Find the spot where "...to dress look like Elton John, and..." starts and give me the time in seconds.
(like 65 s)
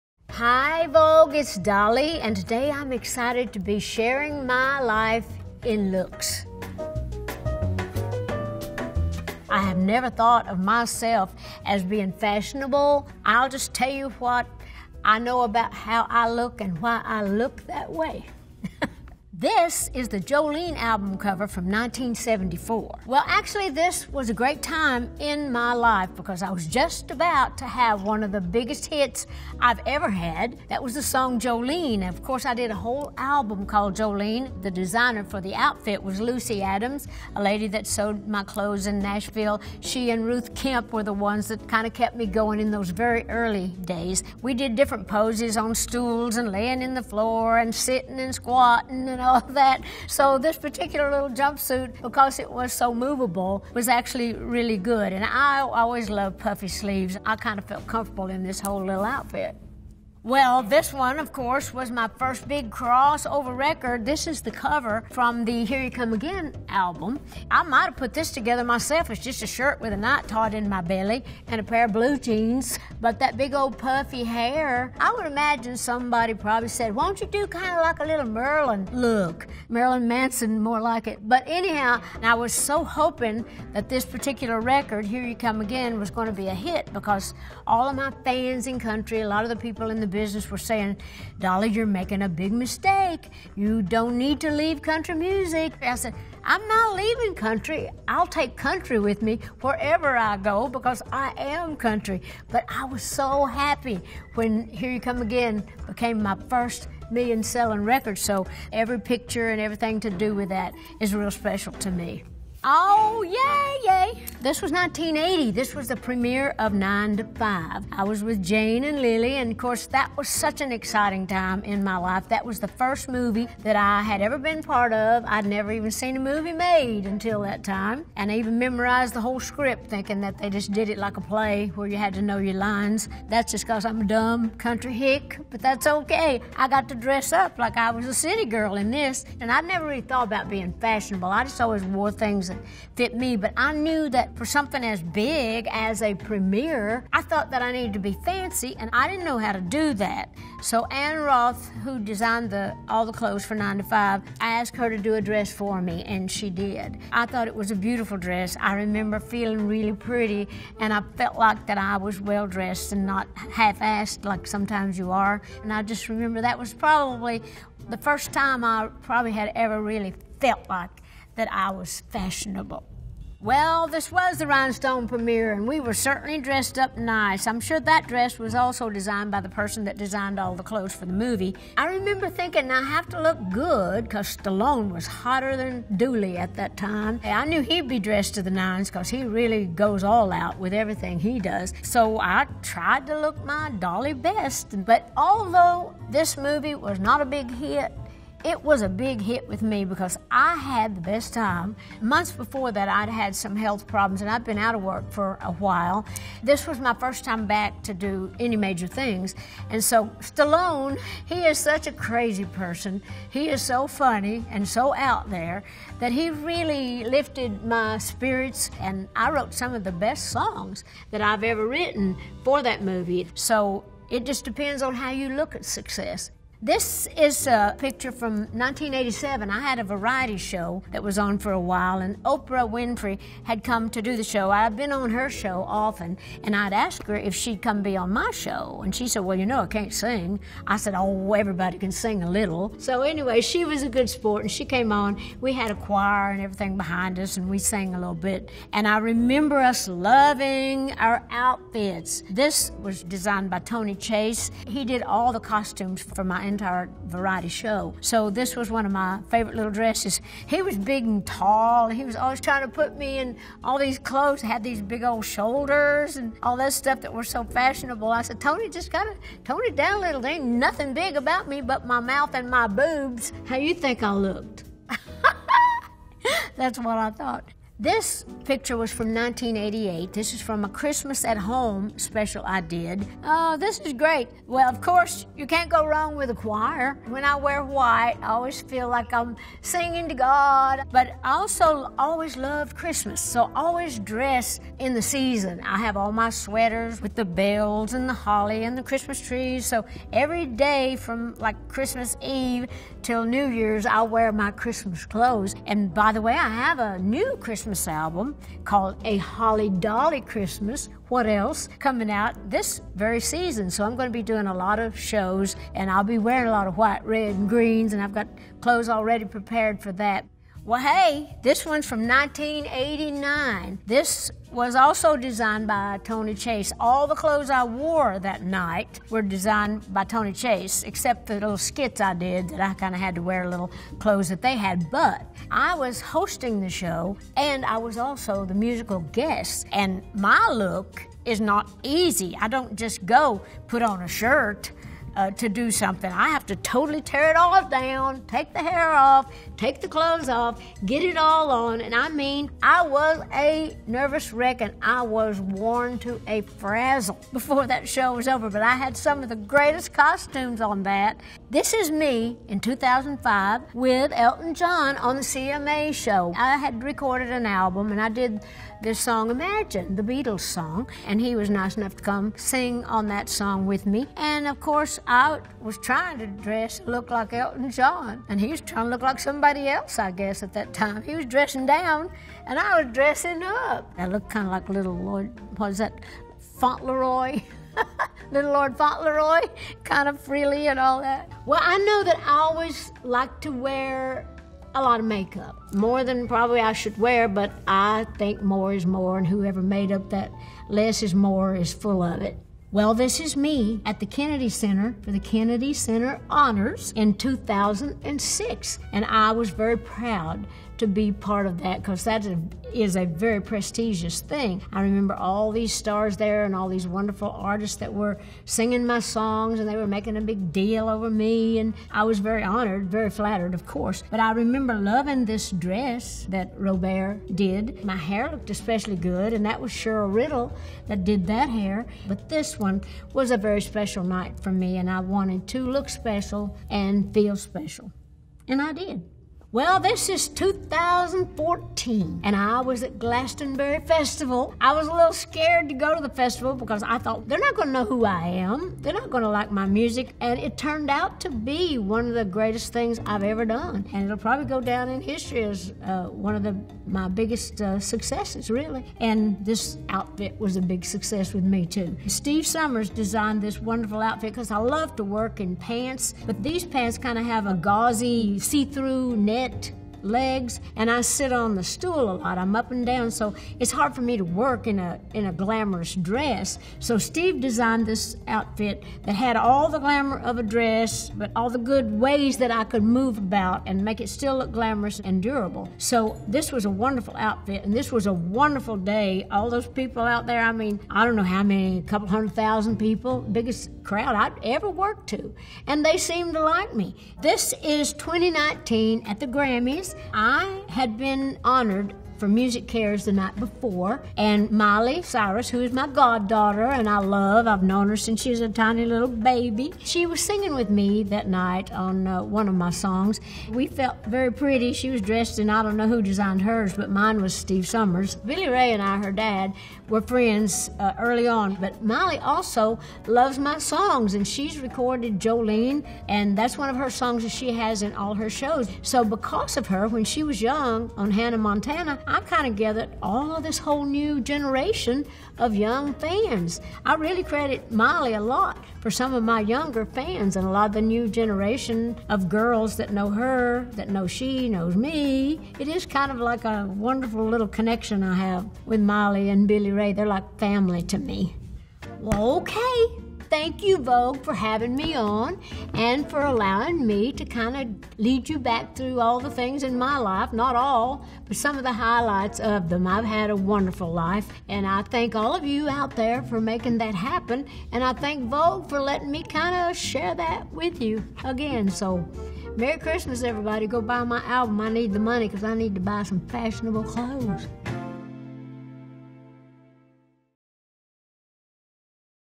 376 s.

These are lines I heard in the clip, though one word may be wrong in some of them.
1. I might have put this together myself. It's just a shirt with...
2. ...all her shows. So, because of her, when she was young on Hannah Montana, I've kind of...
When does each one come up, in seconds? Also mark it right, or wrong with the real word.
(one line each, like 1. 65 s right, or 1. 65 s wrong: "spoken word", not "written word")
1. 67 s right
2. 527 s right.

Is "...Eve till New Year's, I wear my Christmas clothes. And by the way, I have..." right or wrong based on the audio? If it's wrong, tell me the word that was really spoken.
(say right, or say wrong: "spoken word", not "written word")
right.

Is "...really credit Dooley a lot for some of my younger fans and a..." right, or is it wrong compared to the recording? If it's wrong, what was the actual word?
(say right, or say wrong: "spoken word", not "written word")
wrong: "Miley", not "Dooley".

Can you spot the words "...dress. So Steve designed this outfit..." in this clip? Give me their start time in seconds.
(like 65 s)
475 s.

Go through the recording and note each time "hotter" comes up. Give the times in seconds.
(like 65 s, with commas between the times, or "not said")
185 s.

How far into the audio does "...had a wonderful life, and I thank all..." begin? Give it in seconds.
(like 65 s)
563 s.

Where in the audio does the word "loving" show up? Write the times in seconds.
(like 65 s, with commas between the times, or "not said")
249 s, 424 s.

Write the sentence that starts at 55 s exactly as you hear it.
And I always love puffy sleeves.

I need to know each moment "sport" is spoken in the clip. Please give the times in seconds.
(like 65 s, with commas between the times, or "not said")
244 s.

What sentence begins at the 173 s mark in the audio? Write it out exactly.
Well, this was the Rhinestone premiere, and we were certainly dressed up nice.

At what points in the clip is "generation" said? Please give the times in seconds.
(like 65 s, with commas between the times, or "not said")
534 s, 541 s.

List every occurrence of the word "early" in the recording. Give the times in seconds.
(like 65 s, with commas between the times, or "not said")
43 s, 520 s.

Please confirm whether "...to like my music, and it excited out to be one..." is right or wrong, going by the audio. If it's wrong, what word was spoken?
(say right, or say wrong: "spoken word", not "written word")
wrong: "turned", not "excited".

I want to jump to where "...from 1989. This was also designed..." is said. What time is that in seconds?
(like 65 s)
321 s.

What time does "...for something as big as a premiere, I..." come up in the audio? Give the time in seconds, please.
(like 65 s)
144 s.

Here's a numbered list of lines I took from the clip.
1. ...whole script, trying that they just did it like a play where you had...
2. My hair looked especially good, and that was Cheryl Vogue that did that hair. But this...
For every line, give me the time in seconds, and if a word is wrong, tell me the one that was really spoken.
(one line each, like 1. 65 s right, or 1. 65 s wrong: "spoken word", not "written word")
1. 129 s wrong: "thinking", not "trying"
2. 427 s wrong: "Riddle", not "Vogue".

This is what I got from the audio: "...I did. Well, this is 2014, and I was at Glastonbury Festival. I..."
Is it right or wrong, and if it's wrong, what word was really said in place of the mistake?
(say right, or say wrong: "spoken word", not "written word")
right.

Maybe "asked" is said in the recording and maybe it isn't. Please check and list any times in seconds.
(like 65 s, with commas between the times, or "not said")
154 s, 236 s.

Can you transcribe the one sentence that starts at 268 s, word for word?
I said, Tony, just gotta tone it down a little.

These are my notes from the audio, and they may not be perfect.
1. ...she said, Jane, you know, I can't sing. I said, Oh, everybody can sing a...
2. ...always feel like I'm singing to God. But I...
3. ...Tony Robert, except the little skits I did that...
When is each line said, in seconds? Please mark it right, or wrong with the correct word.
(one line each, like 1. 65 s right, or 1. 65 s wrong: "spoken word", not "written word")
1. 238 s wrong: "Well", not "Jane"
2. 288 s right
3. 330 s wrong: "Chase", not "Robert".